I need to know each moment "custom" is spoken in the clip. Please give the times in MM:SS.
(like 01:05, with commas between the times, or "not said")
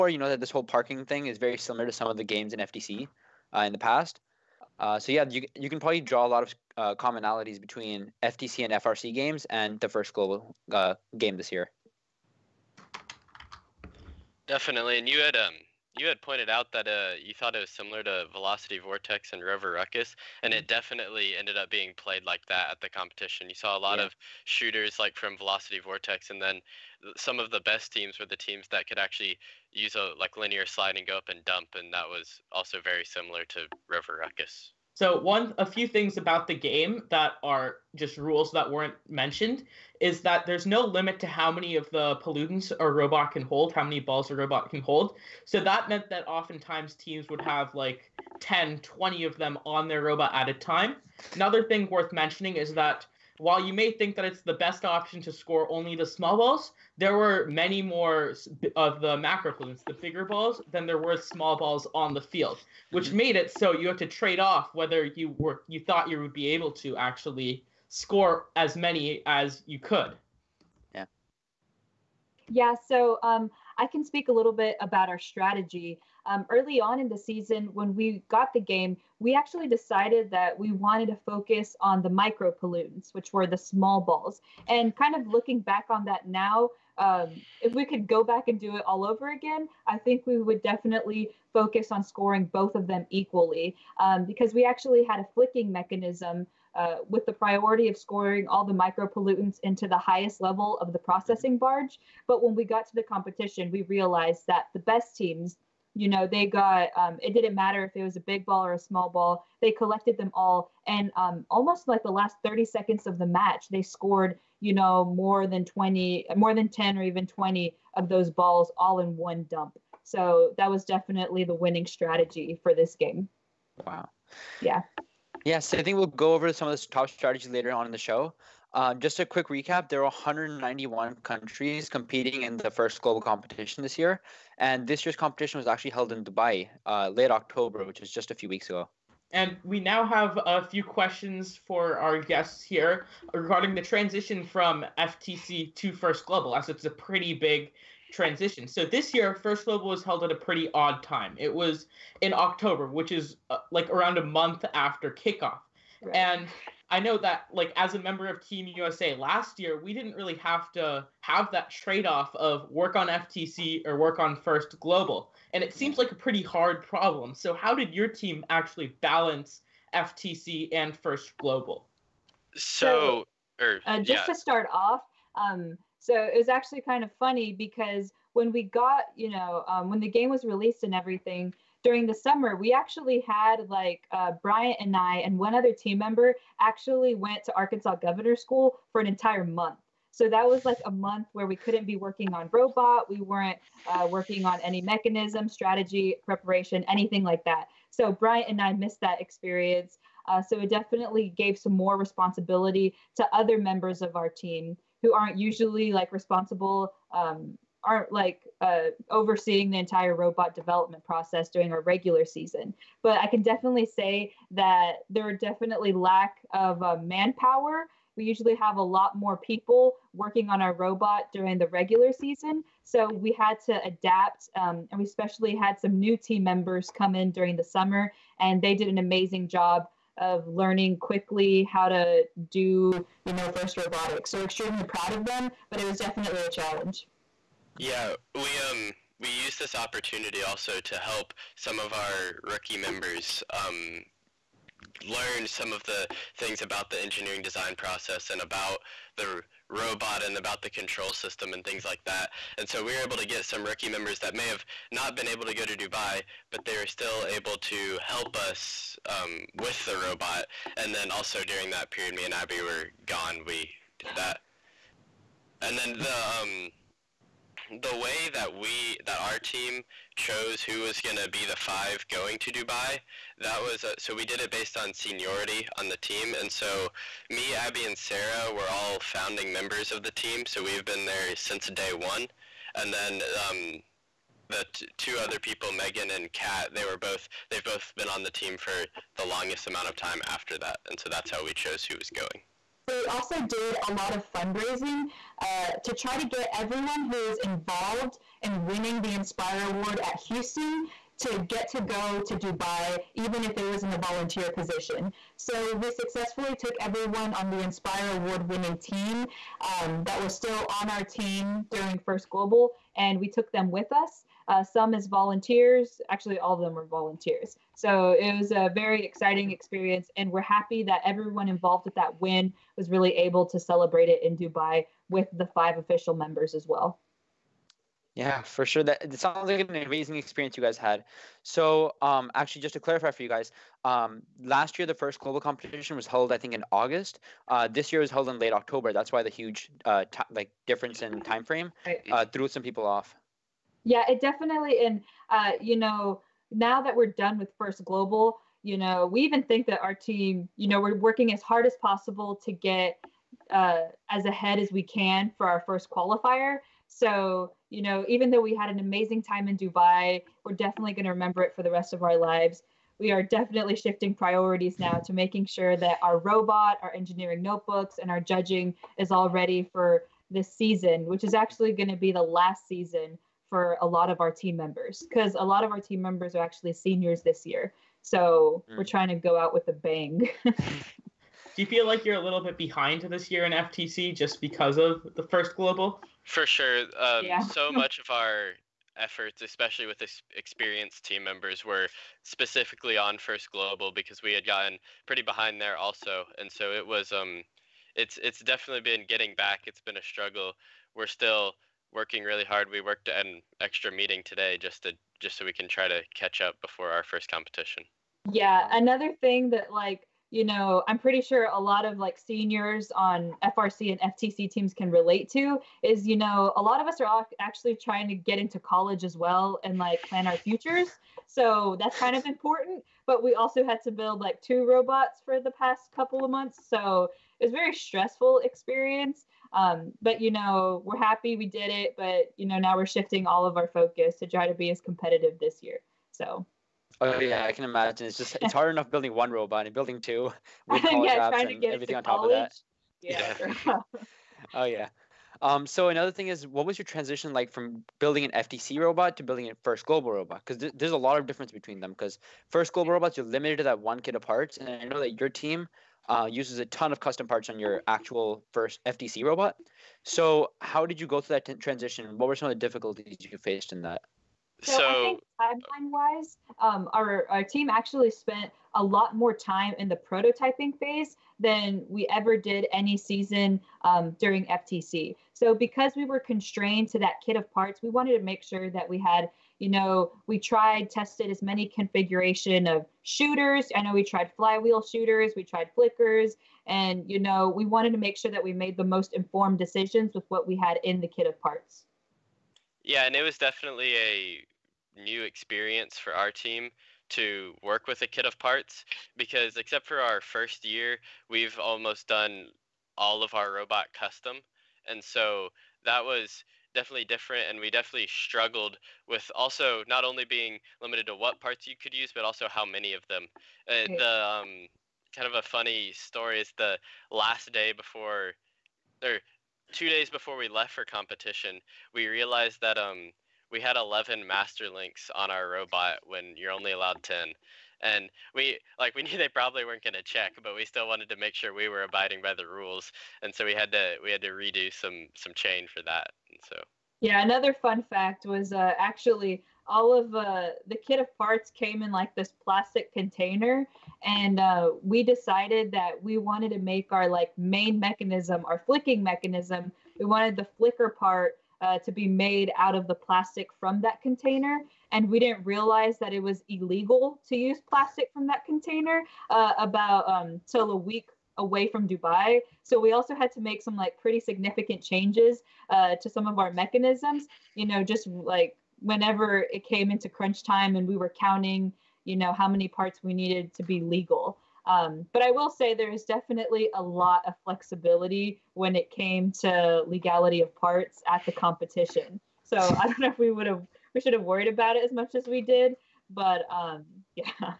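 07:36, 08:23.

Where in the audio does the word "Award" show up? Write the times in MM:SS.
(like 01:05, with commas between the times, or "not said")
04:59, 05:08.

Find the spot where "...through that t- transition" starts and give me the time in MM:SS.
07:41.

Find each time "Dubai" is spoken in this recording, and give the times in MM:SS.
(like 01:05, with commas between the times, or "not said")
02:16, 04:15, 04:32, 05:02, 05:24, 05:59, 09:21.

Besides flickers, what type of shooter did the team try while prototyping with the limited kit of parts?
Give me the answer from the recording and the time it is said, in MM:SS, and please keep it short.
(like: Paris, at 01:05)
flywheel shooters, at 08:04.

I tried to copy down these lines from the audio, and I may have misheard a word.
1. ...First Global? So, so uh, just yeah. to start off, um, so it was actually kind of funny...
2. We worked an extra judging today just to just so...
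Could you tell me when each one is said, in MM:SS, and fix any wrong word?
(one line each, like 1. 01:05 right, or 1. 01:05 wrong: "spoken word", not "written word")
1. 02:50 right
2. 06:42 wrong: "meeting", not "judging".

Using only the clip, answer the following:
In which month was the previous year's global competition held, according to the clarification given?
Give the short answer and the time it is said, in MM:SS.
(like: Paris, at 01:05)
August, at 05:36.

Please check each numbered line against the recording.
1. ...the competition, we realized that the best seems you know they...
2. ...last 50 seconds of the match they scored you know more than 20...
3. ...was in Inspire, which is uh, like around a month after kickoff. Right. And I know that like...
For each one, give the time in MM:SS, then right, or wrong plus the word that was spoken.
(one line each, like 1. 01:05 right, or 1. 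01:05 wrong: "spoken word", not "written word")
1. 01:42 wrong: "teams", not "seems"
2. 01:52 wrong: "30", not "50"
3. 02:31 wrong: "October", not "Inspire".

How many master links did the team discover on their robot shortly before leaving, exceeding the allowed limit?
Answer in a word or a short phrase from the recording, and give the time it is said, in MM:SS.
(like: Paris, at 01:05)
11, at 08:43.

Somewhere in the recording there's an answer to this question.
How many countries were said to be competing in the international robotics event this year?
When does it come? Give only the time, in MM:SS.
02:10.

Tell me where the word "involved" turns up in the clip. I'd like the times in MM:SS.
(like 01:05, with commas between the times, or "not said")
04:57, 05:21.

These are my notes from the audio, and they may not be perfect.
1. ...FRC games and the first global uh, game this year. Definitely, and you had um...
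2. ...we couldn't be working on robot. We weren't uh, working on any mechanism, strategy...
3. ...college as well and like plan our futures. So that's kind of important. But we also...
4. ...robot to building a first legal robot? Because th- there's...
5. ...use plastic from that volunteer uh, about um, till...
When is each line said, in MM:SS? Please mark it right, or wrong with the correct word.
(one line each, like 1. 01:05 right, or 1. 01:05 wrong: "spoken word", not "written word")
1. 00:08 right
2. 03:11 right
3. 06:58 right
4. 07:28 wrong: "global", not "legal"
5. 09:17 wrong: "container", not "volunteer".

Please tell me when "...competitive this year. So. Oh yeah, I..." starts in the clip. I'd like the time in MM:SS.
07:14.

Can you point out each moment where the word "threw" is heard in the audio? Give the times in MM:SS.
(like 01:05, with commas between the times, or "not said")
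05:42.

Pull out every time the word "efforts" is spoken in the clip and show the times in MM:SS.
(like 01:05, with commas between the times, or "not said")
06:28.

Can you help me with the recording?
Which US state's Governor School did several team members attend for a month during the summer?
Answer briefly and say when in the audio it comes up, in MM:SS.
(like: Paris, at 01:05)
Arkansas, at 03:07.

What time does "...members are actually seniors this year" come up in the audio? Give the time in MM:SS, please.
06:16.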